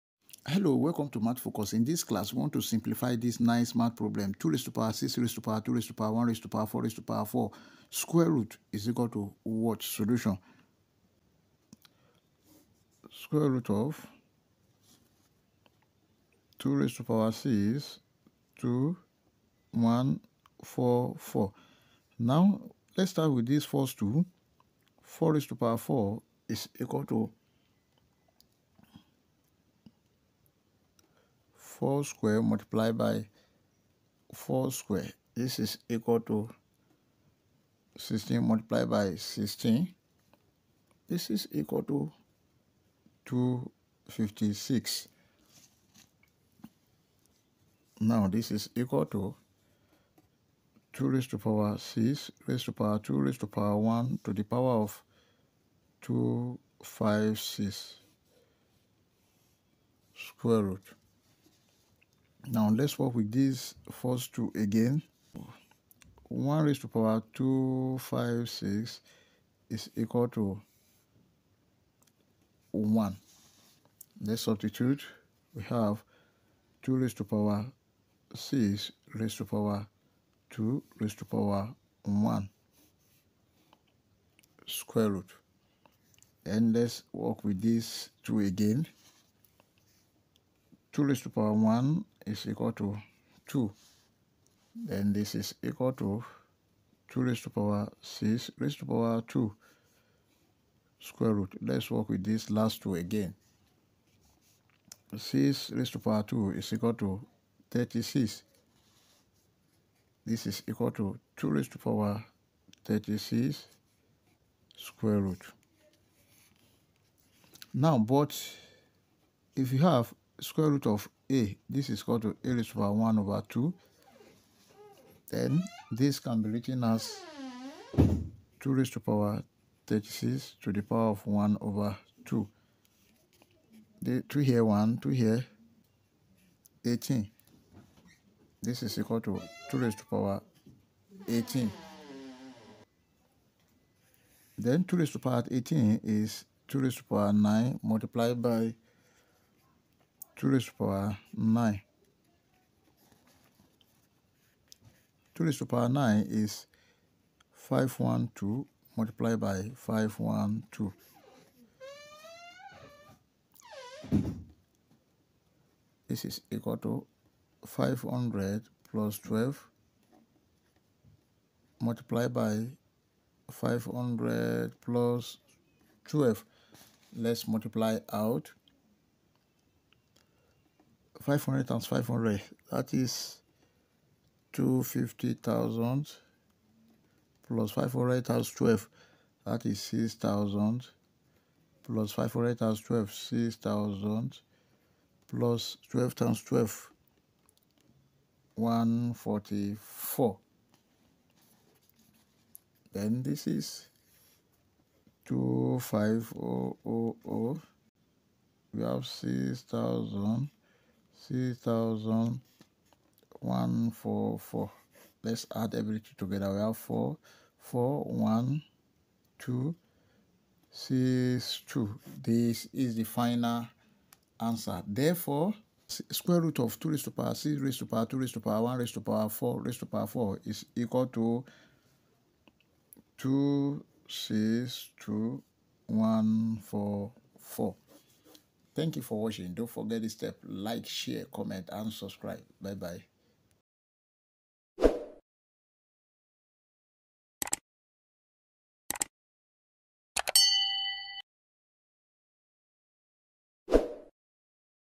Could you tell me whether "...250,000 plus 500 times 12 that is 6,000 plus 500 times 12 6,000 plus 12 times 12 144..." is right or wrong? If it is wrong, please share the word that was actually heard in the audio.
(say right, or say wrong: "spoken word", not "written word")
right.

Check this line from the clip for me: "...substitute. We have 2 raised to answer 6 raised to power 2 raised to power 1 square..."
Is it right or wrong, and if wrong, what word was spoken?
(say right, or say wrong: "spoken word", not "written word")
wrong: "power", not "answer".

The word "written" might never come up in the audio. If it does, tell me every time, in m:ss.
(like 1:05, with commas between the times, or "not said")
2:06.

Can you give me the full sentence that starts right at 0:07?
Square root is equal to what solution?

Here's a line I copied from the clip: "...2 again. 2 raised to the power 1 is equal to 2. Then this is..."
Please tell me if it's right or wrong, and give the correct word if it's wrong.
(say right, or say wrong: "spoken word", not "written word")
right.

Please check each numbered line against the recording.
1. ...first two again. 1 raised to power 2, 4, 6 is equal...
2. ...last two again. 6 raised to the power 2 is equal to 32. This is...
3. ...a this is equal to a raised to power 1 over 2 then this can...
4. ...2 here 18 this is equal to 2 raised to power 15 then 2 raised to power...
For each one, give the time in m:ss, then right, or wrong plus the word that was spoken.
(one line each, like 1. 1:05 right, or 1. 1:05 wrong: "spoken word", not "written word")
1. 1:03 wrong: "5", not "4"
2. 1:42 wrong: "36", not "32"
3. 2:01 right
4. 2:14 wrong: "18", not "15".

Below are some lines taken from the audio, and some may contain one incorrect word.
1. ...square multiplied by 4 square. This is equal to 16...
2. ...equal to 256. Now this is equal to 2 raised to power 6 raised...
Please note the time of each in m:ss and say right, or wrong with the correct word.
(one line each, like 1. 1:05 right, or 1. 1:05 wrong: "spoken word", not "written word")
1. 0:32 right
2. 0:41 right.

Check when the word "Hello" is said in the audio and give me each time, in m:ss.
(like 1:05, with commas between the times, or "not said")
0:00.